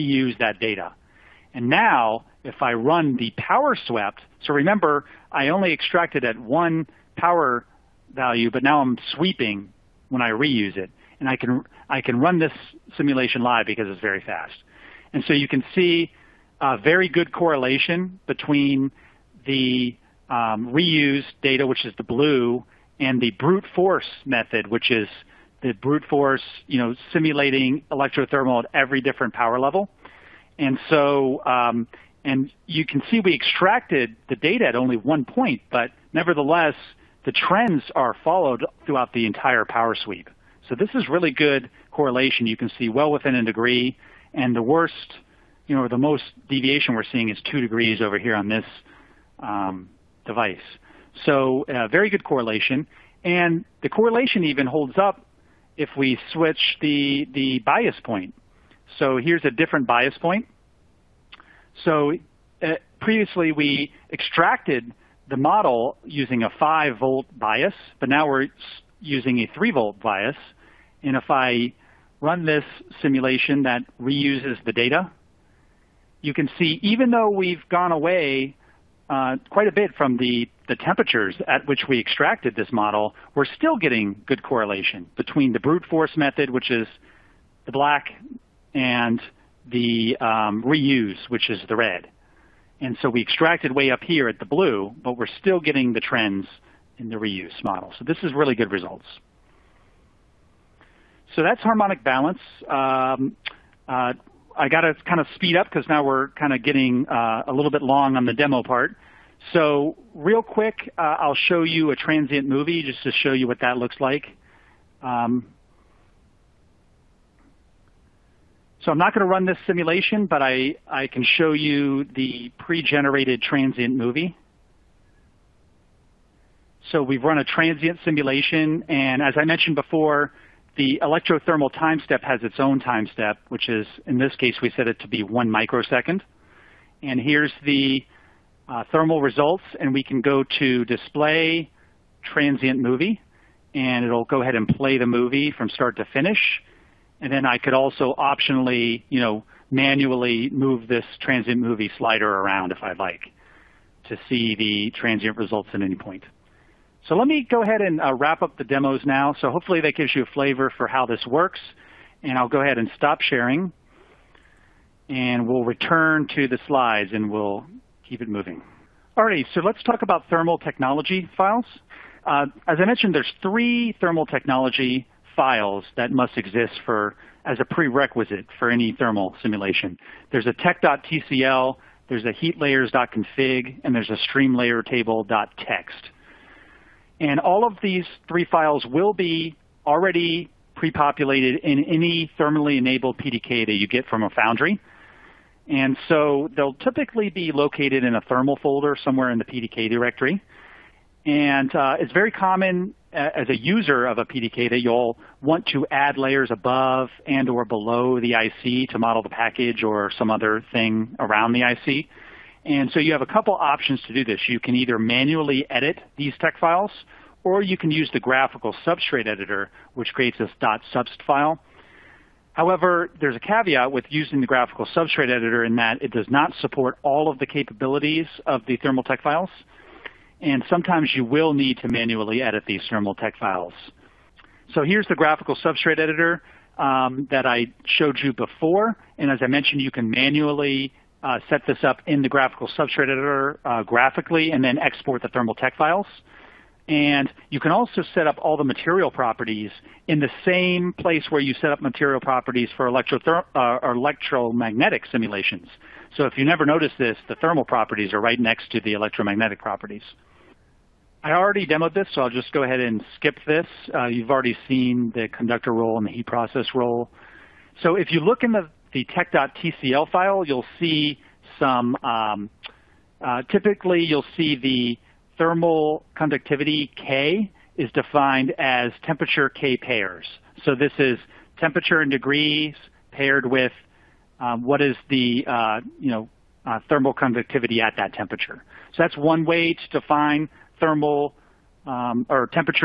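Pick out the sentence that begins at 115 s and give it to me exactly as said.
Um, so I'm not going to run this simulation, but I, I can show you the pre-generated transient movie.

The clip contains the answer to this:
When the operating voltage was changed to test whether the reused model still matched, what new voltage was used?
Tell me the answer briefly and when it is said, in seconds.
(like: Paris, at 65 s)
3 volts, at 69 s.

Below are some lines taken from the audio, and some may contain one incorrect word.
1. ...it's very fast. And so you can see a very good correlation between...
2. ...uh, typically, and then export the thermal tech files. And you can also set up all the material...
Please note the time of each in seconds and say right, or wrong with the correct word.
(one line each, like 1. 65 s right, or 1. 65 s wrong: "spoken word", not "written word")
1. 13 s right
2. 243 s wrong: "graphically", not "typically".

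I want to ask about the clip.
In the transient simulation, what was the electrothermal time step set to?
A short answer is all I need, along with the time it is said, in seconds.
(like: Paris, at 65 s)
1 microsecond, at 135 s.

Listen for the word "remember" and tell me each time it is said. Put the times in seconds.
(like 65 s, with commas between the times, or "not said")
4 s.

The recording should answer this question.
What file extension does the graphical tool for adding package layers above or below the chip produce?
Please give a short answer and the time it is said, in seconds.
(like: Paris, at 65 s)
.subst, at 220 s.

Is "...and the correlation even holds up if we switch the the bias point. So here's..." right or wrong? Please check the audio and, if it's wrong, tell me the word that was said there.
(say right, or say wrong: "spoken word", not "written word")
right.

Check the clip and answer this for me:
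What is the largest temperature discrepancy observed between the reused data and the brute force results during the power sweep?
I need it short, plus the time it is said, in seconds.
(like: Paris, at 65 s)
2 degrees, at 47 s.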